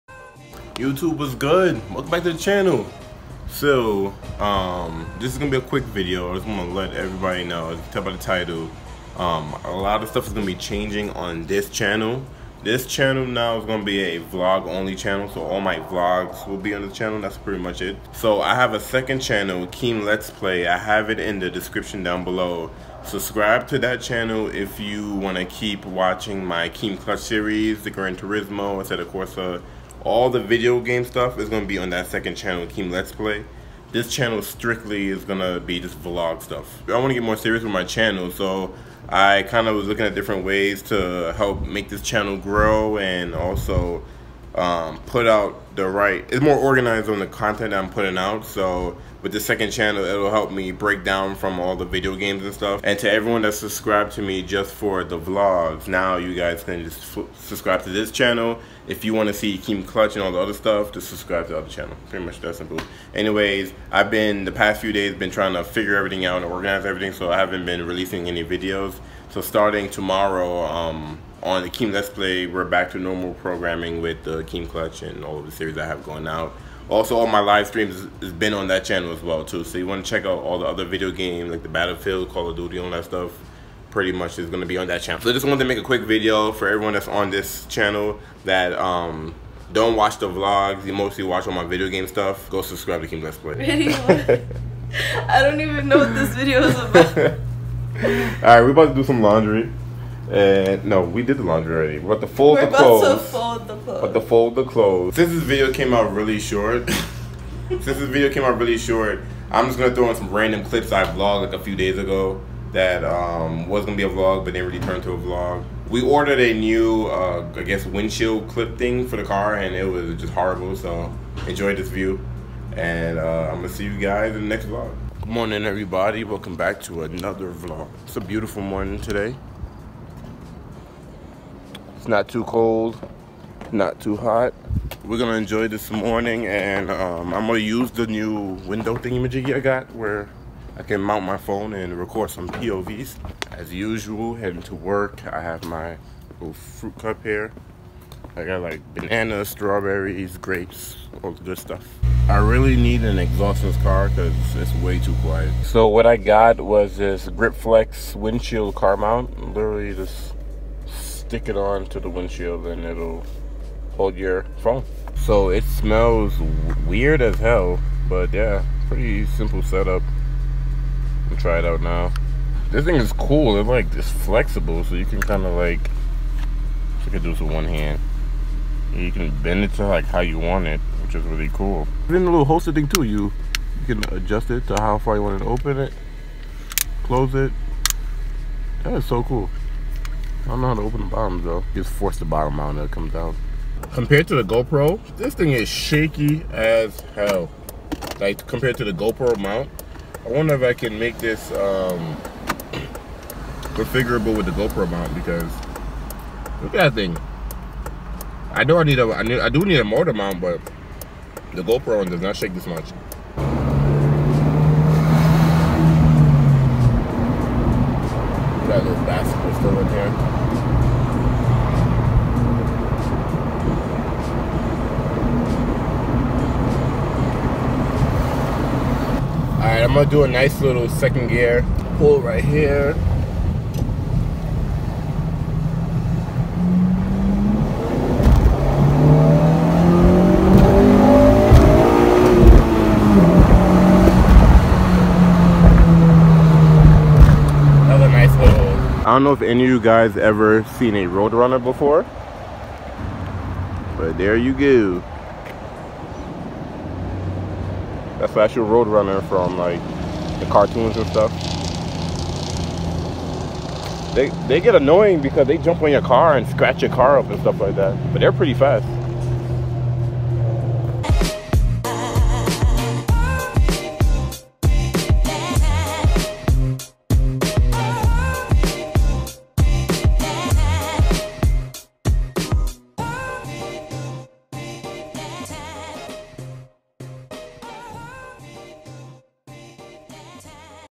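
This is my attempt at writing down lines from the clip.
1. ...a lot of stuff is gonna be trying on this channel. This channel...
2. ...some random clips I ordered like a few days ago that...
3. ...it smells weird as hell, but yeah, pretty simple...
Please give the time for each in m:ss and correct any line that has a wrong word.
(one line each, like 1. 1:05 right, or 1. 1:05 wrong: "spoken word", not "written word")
1. 0:09 wrong: "changing", not "trying"
2. 1:50 wrong: "vlogged", not "ordered"
3. 2:45 right.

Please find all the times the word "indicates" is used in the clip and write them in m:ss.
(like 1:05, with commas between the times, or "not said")
not said.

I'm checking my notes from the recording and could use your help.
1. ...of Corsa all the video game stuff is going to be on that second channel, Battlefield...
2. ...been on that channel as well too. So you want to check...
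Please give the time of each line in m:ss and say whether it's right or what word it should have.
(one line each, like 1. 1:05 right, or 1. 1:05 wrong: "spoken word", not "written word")
1. 0:28 wrong: "Keem", not "Battlefield"
2. 1:18 right.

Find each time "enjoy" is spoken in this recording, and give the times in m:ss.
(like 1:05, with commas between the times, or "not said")
2:01, 2:15.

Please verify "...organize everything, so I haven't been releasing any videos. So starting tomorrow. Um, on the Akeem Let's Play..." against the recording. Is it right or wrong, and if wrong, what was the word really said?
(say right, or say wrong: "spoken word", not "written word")
right.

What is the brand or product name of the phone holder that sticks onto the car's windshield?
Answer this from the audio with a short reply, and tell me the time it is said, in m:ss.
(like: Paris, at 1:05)
Grip Flex, at 2:37.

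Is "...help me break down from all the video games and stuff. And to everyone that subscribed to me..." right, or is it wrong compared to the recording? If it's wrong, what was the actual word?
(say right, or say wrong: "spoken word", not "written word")
right.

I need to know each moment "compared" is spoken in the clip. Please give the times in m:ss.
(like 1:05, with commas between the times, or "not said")
3:13, 3:18.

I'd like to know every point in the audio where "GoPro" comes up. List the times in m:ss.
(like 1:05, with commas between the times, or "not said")
3:14, 3:18, 3:24, 3:31.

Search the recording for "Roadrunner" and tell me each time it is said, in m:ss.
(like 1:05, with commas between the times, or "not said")
4:11, 4:18.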